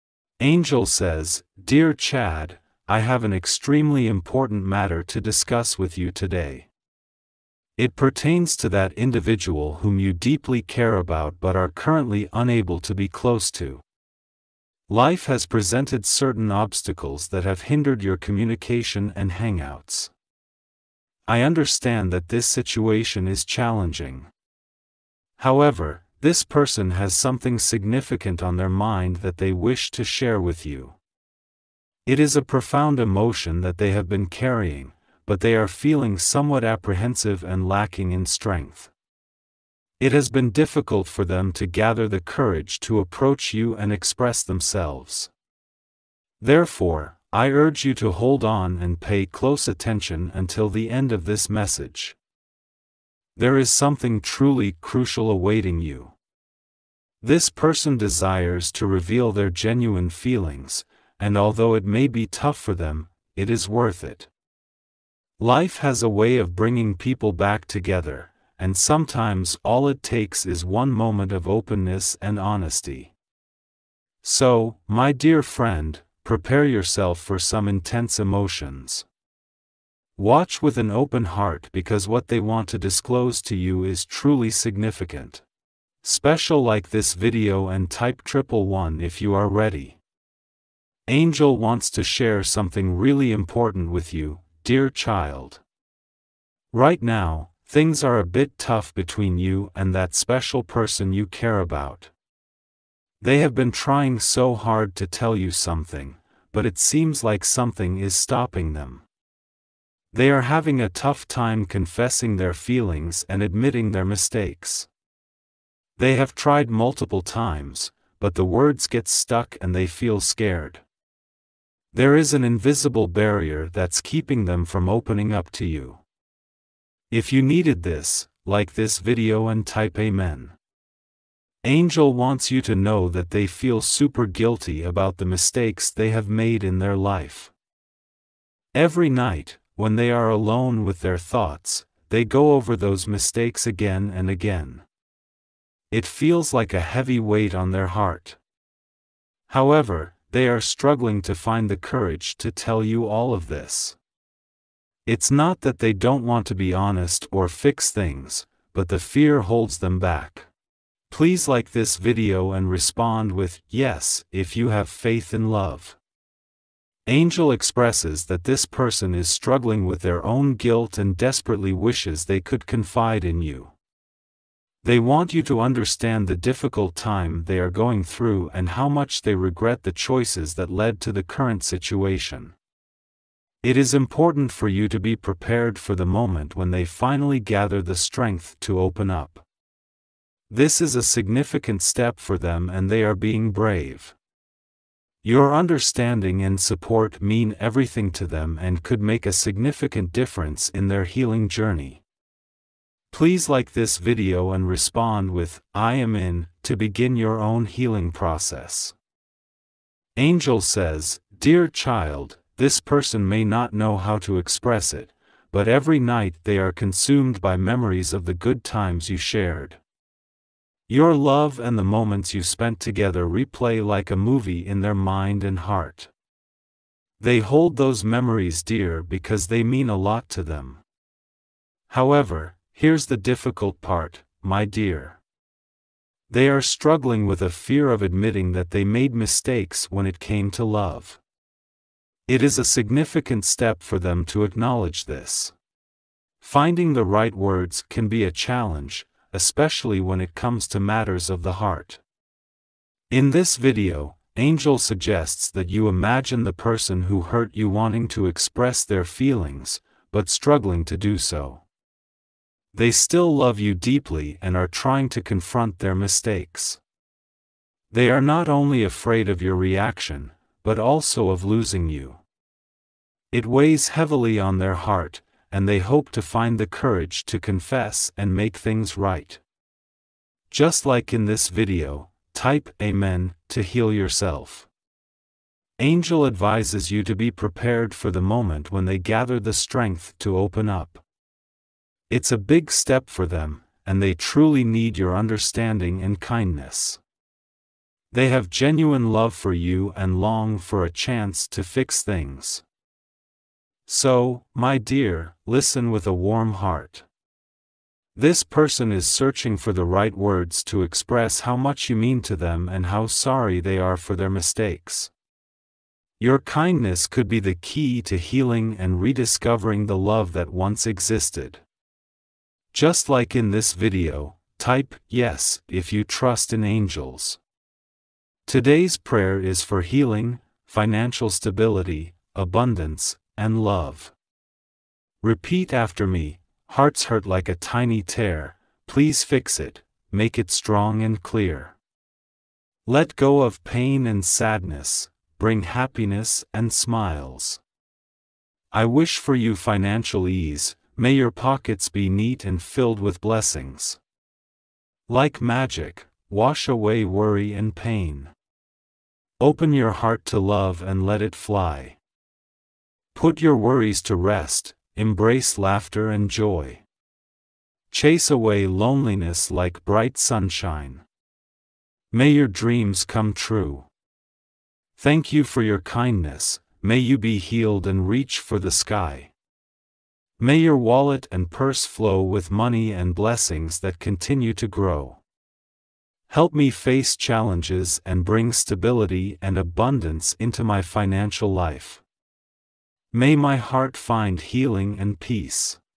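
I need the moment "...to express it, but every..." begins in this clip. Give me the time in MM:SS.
03:34.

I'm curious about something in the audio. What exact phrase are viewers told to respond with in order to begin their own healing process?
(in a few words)
I am in.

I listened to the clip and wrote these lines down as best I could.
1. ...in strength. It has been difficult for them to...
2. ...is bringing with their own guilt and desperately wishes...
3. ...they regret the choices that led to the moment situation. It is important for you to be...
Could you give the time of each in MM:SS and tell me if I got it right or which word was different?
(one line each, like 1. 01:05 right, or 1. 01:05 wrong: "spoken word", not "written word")
1. 00:38 right
2. 02:49 wrong: "struggling", not "bringing"
3. 02:59 wrong: "current", not "moment".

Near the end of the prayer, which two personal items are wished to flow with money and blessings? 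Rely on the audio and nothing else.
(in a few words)
wallet and purse.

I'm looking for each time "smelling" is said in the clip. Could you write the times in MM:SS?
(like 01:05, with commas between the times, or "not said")
not said.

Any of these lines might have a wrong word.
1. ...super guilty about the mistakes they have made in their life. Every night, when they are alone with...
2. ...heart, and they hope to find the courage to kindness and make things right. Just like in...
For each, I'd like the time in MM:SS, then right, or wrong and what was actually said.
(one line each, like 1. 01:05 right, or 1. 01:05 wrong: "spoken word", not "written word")
1. 02:13 right
2. 04:34 wrong: "confess", not "kindness".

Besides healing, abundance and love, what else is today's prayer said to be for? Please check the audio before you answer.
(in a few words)
financial stability.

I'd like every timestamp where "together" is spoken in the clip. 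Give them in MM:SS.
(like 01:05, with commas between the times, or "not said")
01:07, 03:42.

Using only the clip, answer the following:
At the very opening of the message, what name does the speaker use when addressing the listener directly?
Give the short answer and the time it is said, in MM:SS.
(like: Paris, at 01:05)
Chad, at 00:01.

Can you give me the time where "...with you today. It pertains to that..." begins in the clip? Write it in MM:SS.
00:05.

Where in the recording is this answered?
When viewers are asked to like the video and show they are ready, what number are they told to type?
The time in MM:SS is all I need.
01:28.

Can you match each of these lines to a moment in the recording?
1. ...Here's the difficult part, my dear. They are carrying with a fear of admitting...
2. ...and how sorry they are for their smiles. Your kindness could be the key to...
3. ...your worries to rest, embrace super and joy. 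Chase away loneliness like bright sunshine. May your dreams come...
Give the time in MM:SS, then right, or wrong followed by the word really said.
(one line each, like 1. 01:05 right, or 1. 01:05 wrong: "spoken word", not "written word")
1. 03:52 wrong: "struggling", not "carrying"
2. 05:12 wrong: "mistakes", not "smiles"
3. 06:03 wrong: "laughter", not "super".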